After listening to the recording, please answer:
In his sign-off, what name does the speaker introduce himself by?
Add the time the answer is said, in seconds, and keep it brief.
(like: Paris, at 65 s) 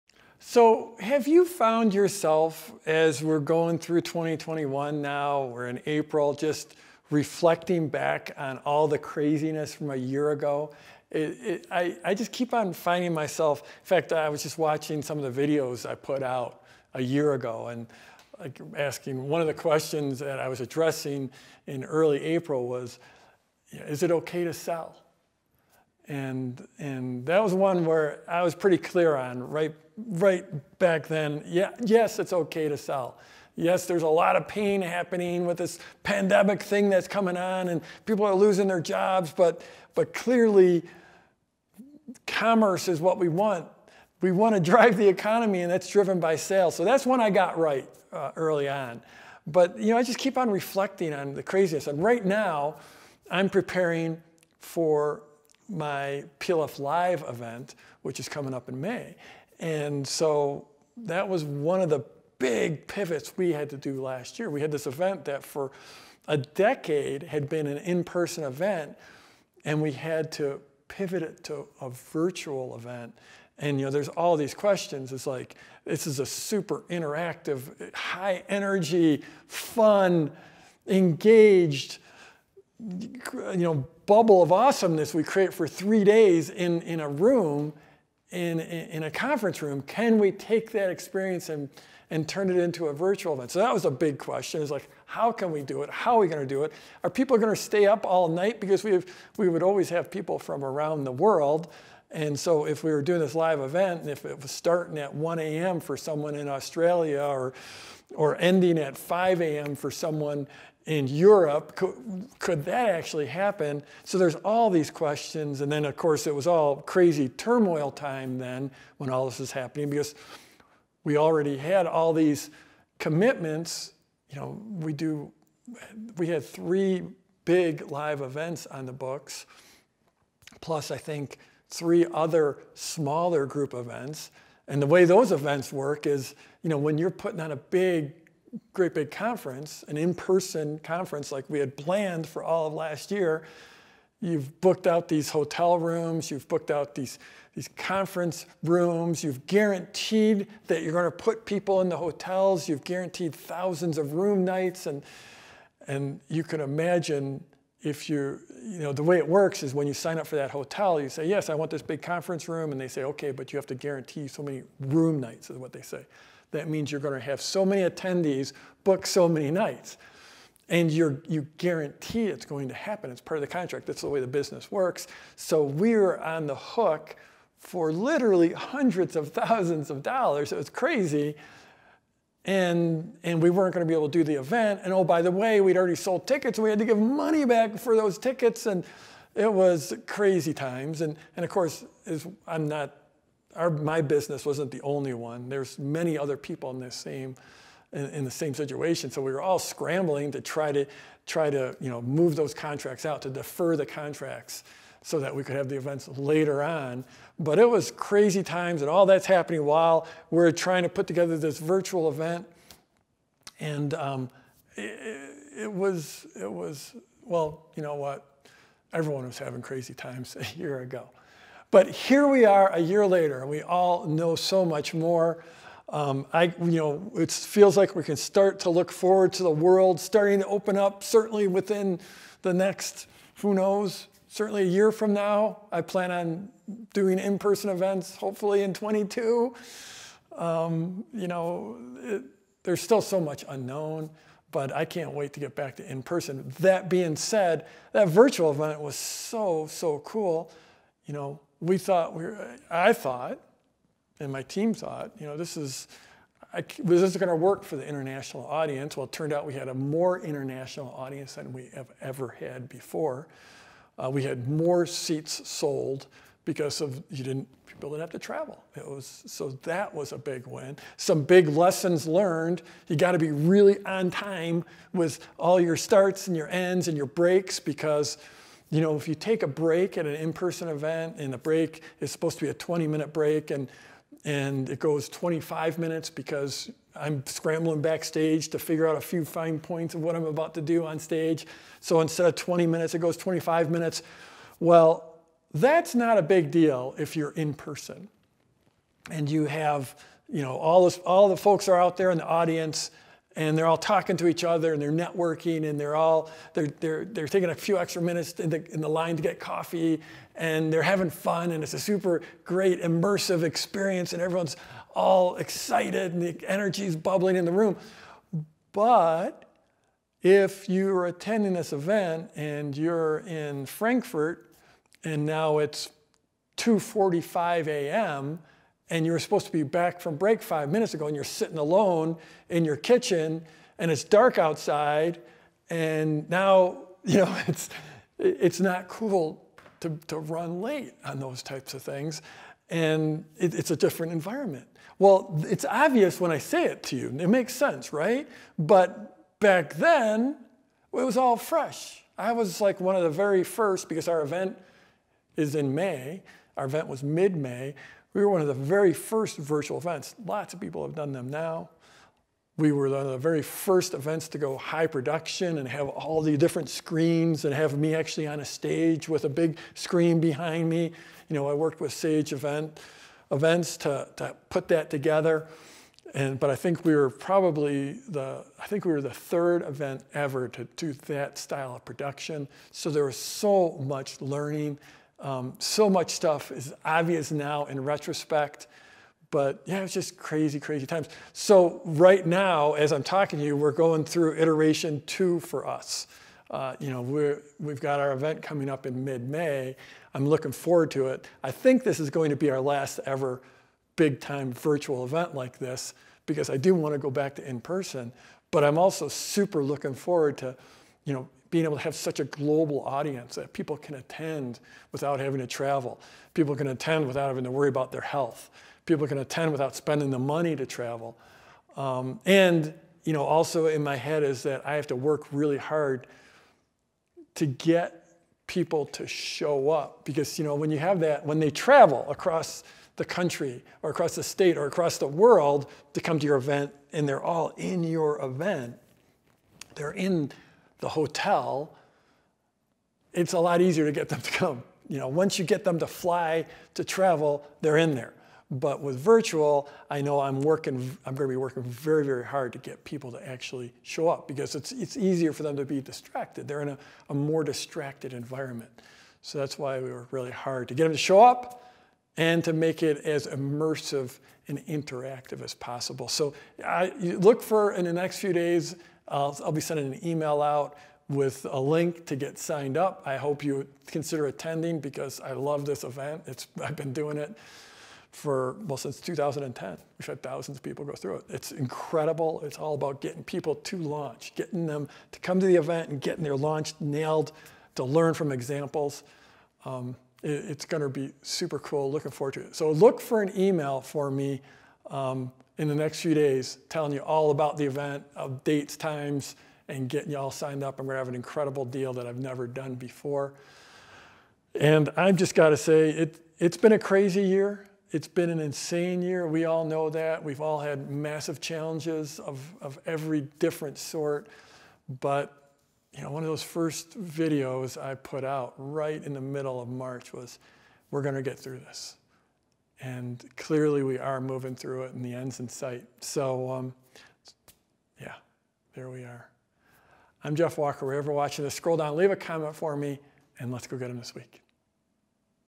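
Jeff Walker, at 530 s.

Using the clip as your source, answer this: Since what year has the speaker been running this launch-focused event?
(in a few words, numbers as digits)
2010.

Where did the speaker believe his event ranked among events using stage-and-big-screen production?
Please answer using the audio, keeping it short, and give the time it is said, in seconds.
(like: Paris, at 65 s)
third, at 378 s.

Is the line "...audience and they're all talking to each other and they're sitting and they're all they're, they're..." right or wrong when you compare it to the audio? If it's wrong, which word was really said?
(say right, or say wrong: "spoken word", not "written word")
wrong: "networking", not "sitting".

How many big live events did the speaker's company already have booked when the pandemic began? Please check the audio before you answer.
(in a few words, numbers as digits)
3.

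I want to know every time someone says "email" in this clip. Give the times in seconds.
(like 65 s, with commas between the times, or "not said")
470 s, 493 s.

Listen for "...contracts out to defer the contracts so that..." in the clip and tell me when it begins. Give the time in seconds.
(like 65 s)
202 s.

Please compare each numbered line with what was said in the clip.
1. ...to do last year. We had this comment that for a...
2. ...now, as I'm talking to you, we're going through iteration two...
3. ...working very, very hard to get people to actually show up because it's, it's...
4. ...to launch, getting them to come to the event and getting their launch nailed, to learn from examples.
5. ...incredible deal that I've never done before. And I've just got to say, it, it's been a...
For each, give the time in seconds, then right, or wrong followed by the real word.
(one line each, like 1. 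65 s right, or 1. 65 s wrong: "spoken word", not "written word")
1. 63 s wrong: "event", not "comment"
2. 392 s right
3. 451 s right
4. 483 s right
5. 501 s right.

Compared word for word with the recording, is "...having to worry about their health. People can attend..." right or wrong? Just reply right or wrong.
right.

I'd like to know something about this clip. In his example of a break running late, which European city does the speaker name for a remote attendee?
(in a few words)
Frankfurt.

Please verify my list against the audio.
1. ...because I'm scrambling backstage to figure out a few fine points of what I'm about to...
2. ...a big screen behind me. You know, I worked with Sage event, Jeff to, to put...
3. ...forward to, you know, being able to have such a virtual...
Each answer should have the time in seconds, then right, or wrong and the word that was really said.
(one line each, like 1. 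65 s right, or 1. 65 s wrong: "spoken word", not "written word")
1. 286 s right
2. 369 s wrong: "Events", not "Jeff"
3. 409 s wrong: "global", not "virtual".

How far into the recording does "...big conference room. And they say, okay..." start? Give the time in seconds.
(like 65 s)
161 s.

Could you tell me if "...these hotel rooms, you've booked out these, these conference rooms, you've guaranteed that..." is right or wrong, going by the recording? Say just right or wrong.
right.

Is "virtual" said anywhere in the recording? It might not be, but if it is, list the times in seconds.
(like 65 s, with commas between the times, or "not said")
71 s, 92 s, 211 s, 248 s, 359 s, 404 s, 448 s.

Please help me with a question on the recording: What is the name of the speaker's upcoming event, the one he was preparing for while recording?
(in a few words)
PLF Live.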